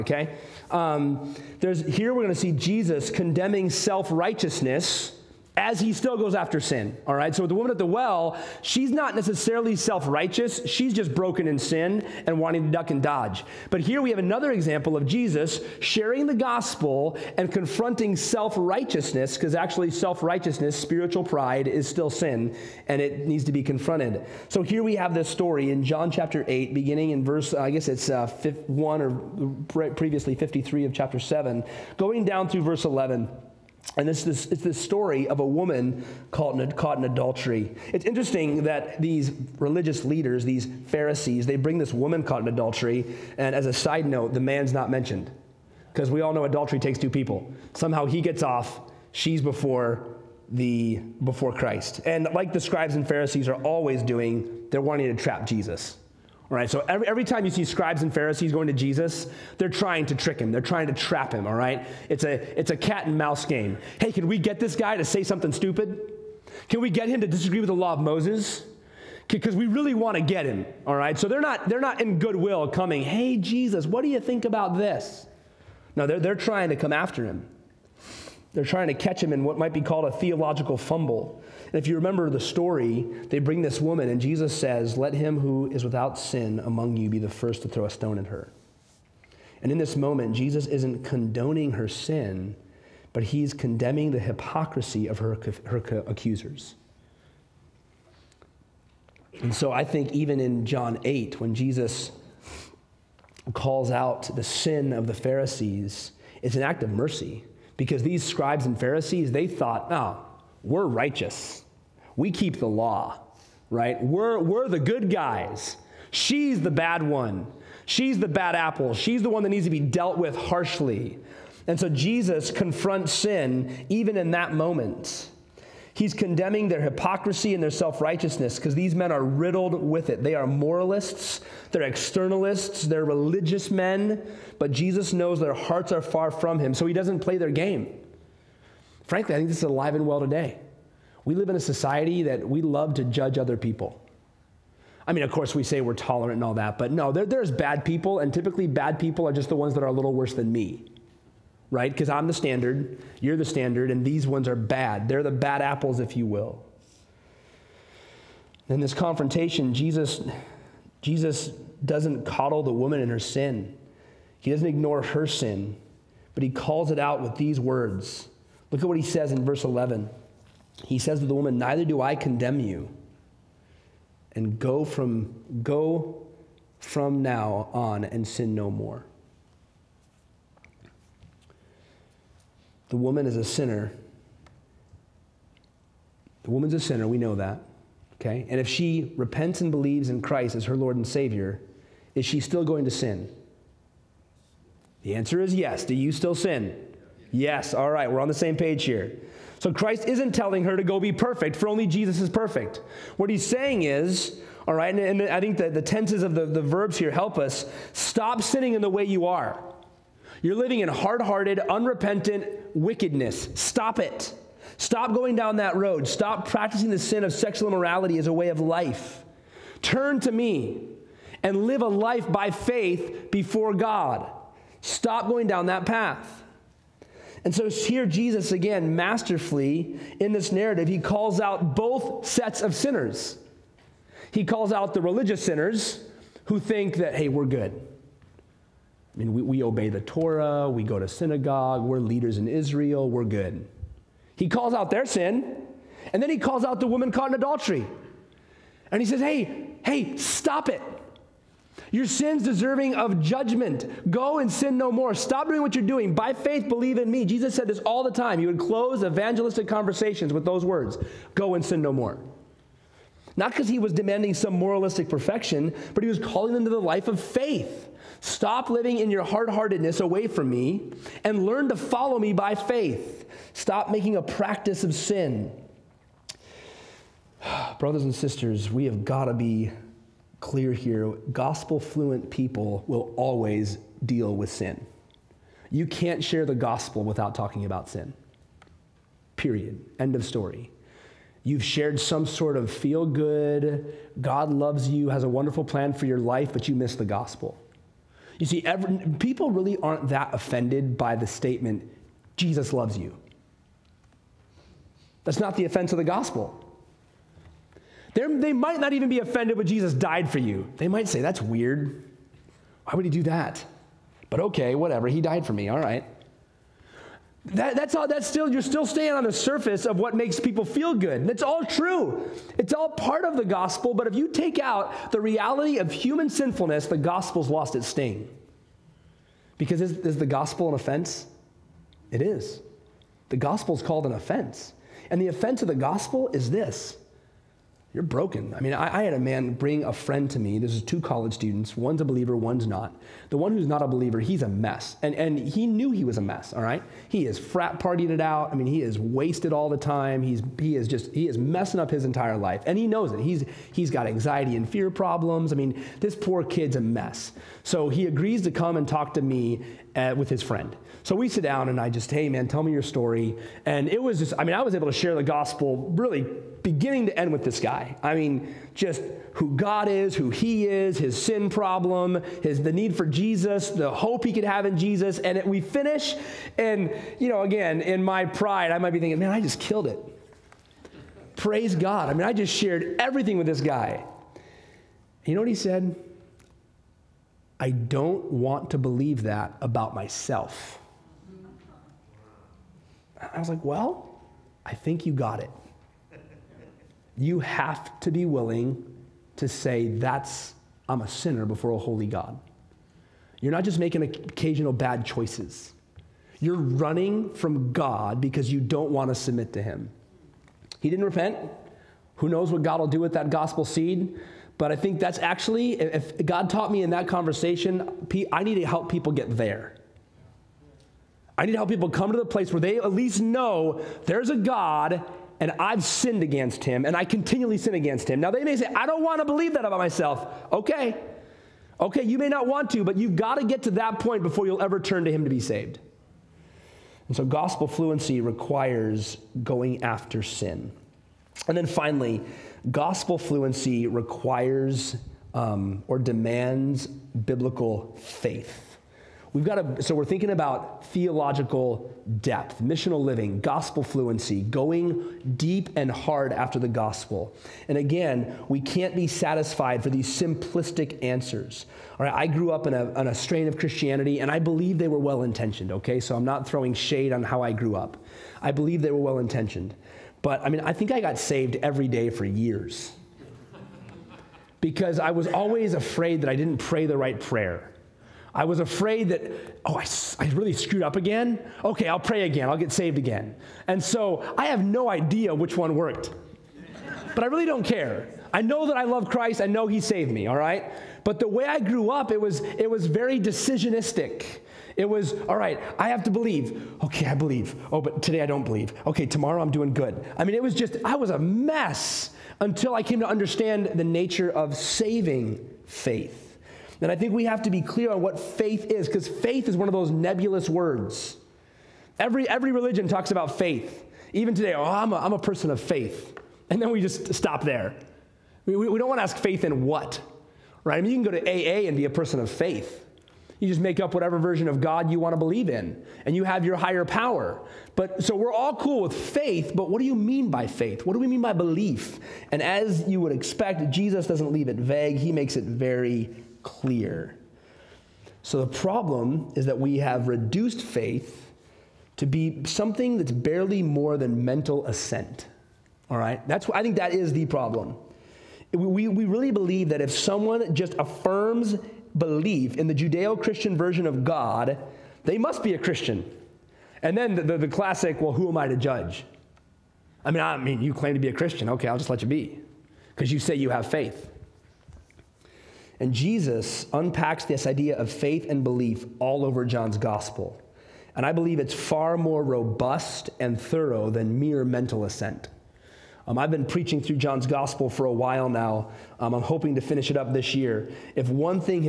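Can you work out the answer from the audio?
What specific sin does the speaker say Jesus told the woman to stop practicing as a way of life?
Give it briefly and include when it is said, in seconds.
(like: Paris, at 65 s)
sexual immorality, at 217 s.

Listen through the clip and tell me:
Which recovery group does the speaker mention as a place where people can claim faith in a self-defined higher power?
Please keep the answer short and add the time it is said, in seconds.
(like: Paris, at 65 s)
AA, at 521 s.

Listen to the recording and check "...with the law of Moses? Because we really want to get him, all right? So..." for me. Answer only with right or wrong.
right.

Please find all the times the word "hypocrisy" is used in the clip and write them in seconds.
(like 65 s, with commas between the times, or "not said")
94 s, 126 s.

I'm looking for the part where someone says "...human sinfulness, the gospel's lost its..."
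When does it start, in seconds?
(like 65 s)
325 s.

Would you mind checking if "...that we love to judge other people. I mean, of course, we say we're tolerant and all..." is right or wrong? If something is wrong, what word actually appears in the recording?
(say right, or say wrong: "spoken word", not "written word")
right.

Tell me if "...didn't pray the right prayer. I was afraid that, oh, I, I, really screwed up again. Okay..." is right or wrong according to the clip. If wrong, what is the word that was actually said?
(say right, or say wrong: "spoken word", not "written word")
right.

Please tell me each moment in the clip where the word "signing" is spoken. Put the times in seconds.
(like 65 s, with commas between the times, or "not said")
not said.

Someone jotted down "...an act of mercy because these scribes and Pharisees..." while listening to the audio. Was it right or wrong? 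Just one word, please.
right.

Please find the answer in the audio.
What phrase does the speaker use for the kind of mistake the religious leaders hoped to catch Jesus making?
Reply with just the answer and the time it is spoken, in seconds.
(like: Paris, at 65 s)
theological fumble, at 80 s.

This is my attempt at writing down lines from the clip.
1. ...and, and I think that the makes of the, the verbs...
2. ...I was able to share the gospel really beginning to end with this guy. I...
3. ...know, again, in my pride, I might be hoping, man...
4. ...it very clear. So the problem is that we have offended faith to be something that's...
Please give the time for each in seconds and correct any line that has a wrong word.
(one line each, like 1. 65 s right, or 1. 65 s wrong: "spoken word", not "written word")
1. 204 s wrong: "tenses", not "makes"
2. 364 s right
3. 377 s wrong: "thinking", not "hoping"
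4. 535 s wrong: "reduced", not "offended".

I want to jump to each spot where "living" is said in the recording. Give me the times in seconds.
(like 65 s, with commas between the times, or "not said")
210 s, 268 s, 453 s.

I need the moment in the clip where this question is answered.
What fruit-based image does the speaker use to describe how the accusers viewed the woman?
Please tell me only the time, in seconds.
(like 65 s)
118 s.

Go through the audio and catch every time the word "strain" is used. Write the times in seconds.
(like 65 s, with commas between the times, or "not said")
463 s.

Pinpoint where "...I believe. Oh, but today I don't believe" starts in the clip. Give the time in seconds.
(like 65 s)
497 s.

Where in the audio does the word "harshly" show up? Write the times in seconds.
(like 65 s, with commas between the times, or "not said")
120 s.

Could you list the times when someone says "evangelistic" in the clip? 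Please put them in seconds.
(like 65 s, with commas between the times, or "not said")
259 s.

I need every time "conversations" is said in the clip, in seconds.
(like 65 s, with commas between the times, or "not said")
259 s, 417 s.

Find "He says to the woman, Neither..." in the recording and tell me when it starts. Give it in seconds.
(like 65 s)
170 s.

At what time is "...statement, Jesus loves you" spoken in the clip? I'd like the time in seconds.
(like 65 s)
301 s.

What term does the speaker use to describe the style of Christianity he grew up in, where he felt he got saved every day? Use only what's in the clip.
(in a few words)
decisionistic.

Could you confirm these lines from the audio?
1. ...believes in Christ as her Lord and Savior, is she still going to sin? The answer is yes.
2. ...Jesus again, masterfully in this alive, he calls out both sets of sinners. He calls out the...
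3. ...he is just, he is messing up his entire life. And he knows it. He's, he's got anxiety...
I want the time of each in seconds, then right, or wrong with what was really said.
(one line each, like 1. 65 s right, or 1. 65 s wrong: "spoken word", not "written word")
1. 189 s right
2. 228 s wrong: "narrative", not "alive"
3. 350 s right.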